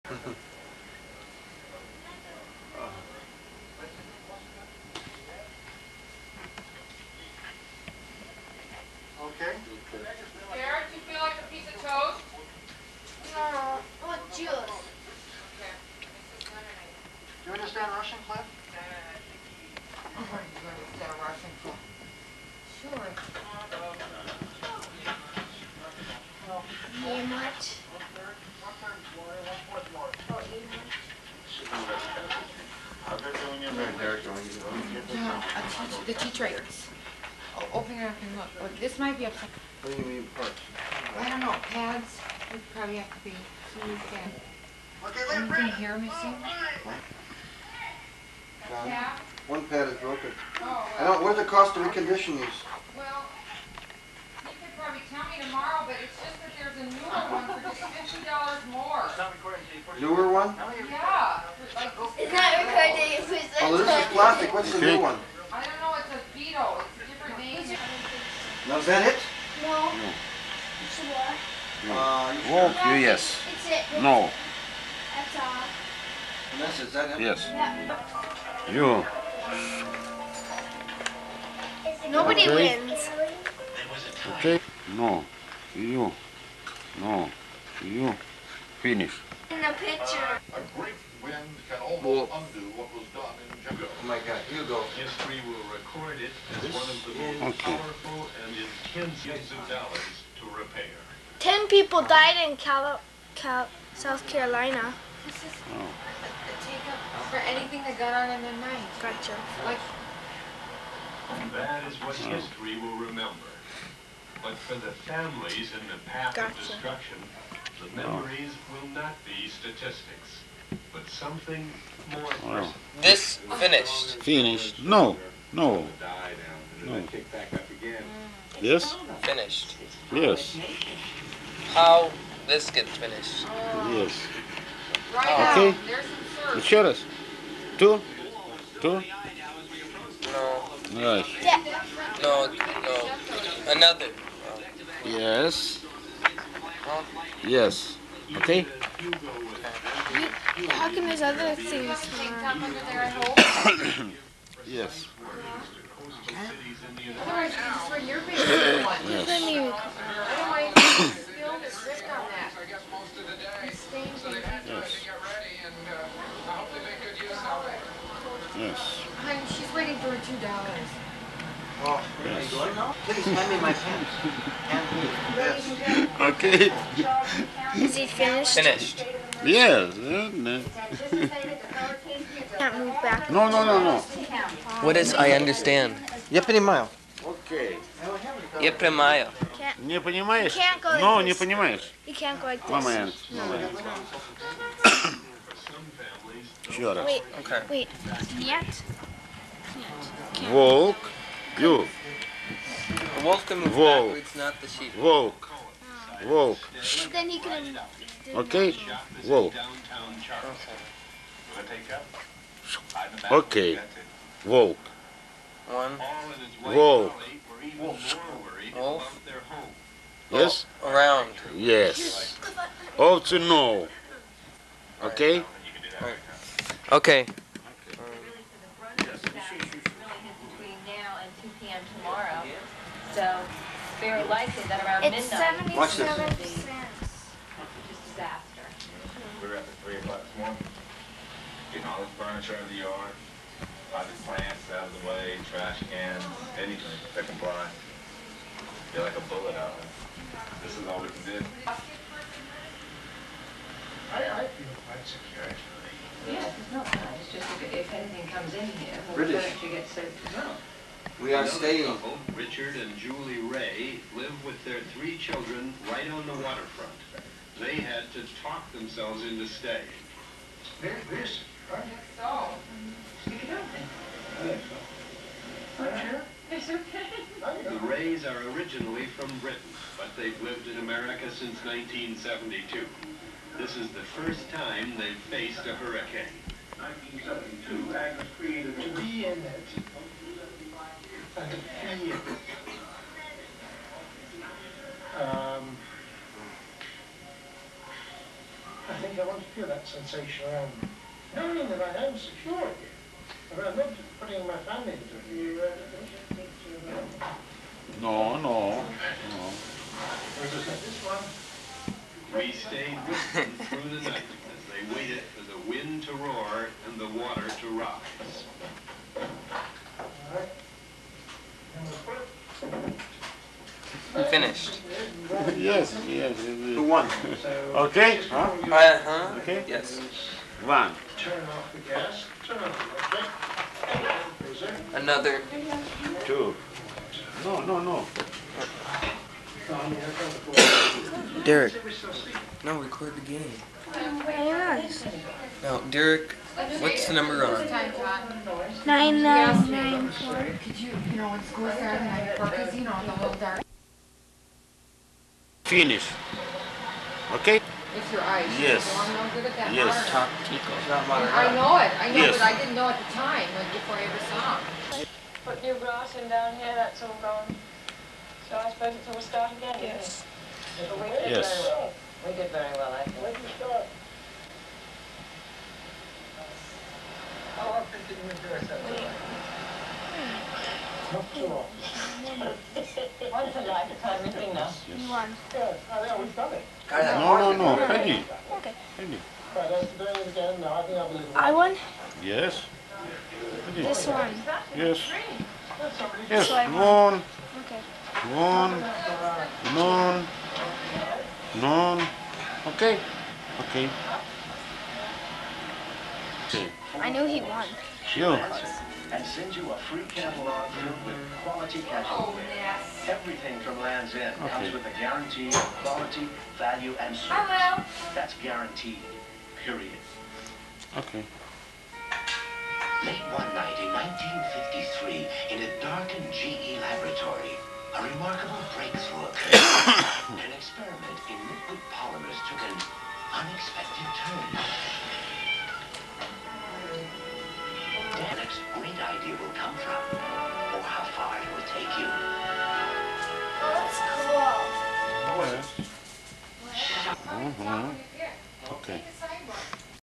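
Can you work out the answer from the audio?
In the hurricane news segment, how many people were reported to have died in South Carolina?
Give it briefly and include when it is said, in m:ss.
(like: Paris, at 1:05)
10, at 1:41.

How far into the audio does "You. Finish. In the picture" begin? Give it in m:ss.
1:27.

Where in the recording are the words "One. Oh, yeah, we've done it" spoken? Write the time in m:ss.
6:25.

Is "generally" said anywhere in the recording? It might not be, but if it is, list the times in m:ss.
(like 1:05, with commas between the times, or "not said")
not said.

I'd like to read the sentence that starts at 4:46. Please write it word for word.
1972, Agnes created to be in it and to feel it.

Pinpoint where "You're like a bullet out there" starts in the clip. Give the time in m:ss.
4:08.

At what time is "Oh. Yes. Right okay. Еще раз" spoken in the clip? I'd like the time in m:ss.
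2:13.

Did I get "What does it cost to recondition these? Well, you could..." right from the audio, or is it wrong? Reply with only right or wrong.
right.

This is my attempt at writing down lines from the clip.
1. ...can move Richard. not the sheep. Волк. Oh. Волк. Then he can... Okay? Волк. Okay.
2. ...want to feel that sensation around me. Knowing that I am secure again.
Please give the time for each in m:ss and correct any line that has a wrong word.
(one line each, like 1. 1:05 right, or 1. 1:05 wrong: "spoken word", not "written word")
1. 3:23 wrong: "Волк", not "Richard"
2. 4:59 right.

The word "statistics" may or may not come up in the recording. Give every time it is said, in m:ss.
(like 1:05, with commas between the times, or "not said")
1:59.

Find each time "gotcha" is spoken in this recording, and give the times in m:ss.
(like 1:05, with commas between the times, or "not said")
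1:49, 1:56.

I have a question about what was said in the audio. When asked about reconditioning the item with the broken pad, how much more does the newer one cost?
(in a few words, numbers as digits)
$50.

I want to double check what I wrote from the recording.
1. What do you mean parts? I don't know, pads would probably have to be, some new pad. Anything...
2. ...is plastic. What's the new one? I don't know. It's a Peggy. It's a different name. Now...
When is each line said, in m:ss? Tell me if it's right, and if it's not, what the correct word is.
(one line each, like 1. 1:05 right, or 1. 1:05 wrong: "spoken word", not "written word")
1. 0:39 right
2. 1:03 wrong: "Beetle", not "Peggy".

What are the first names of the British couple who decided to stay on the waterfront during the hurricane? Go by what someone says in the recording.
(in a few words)
Richard and Julie.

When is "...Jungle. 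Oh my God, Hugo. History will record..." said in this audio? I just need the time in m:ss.
1:33.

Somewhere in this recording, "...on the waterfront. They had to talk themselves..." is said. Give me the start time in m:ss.
4:26.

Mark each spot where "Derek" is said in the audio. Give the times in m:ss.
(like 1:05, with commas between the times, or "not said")
5:41, 5:45.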